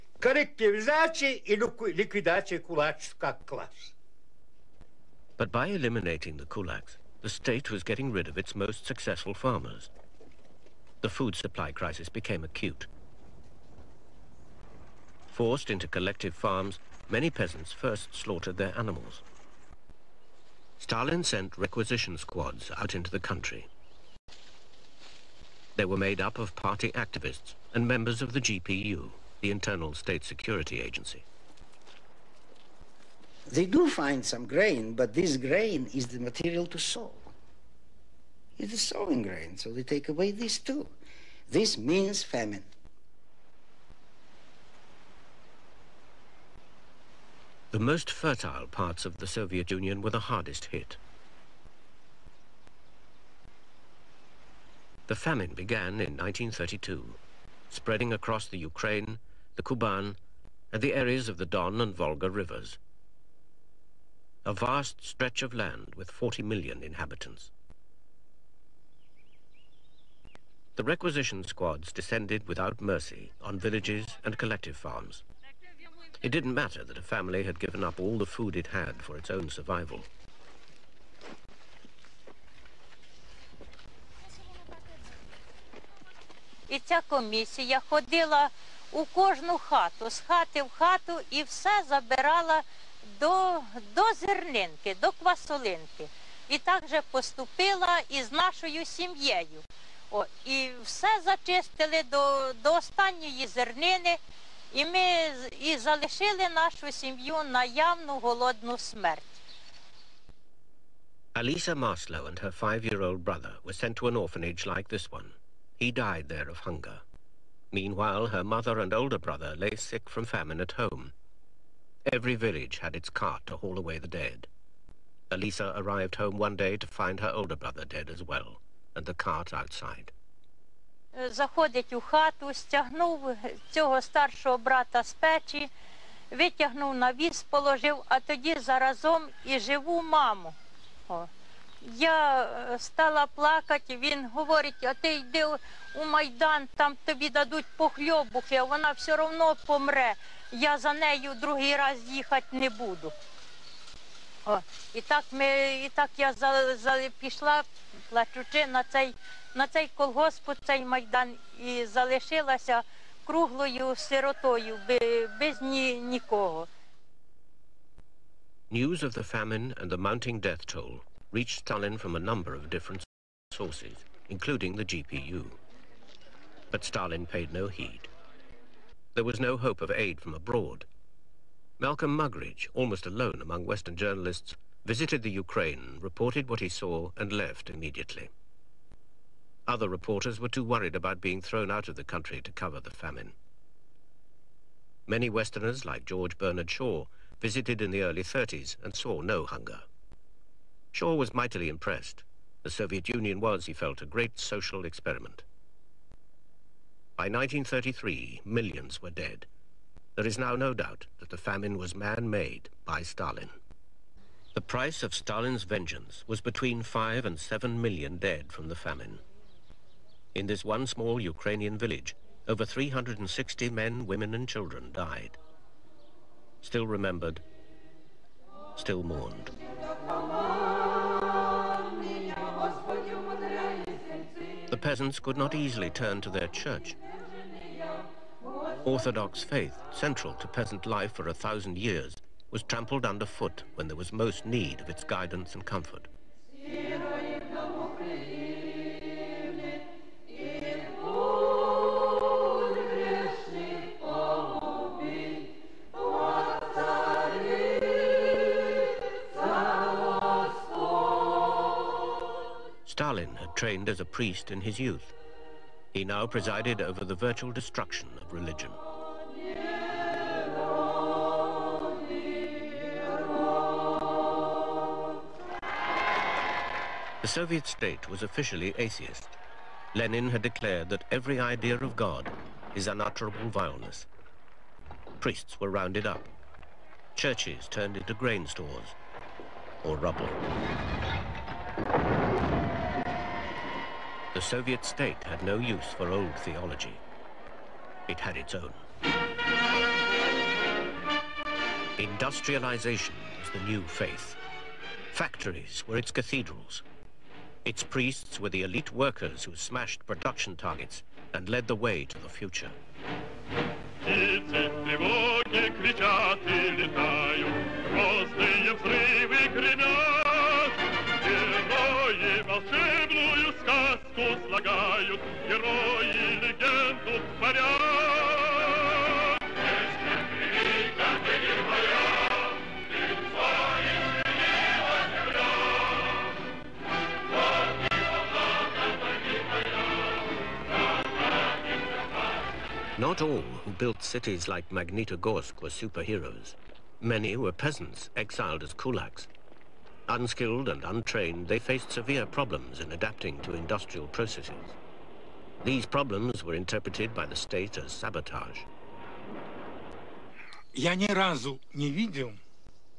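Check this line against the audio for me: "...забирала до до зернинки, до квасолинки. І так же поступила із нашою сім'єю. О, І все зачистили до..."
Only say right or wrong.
right.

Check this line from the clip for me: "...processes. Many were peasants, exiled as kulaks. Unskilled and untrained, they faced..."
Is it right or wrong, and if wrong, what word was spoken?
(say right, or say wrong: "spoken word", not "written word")
wrong: "superheroes", not "processes".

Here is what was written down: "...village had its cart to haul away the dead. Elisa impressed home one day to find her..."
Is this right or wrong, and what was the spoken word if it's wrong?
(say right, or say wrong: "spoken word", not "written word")
wrong: "arrived", not "impressed".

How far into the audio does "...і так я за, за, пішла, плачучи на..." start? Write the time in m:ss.
2:35.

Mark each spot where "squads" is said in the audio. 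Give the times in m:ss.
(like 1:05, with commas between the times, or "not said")
0:22, 1:11.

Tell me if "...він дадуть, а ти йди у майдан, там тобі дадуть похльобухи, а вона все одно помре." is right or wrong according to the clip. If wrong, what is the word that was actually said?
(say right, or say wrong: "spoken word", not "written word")
wrong: "говорить", not "дадуть".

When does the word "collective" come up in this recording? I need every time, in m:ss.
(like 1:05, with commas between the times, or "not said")
0:15, 1:14.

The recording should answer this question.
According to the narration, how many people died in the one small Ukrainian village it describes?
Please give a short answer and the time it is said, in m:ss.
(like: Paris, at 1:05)
over 360, at 3:42.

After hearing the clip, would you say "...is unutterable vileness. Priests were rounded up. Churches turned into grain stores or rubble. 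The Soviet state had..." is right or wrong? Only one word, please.
right.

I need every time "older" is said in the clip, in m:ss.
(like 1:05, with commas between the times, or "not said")
1:58, 2:07.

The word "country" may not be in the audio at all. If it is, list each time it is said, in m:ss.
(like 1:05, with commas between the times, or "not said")
0:23, 3:12.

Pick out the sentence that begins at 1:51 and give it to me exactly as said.
Alisa Maslow and her five year old brother were sent to an orphanage like this one.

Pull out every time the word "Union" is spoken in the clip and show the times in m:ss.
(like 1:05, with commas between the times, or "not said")
0:49, 3:23.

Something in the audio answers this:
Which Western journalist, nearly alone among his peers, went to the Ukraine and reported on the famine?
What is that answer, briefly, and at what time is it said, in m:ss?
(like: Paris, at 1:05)
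Malcolm Muggeridge, at 3:01.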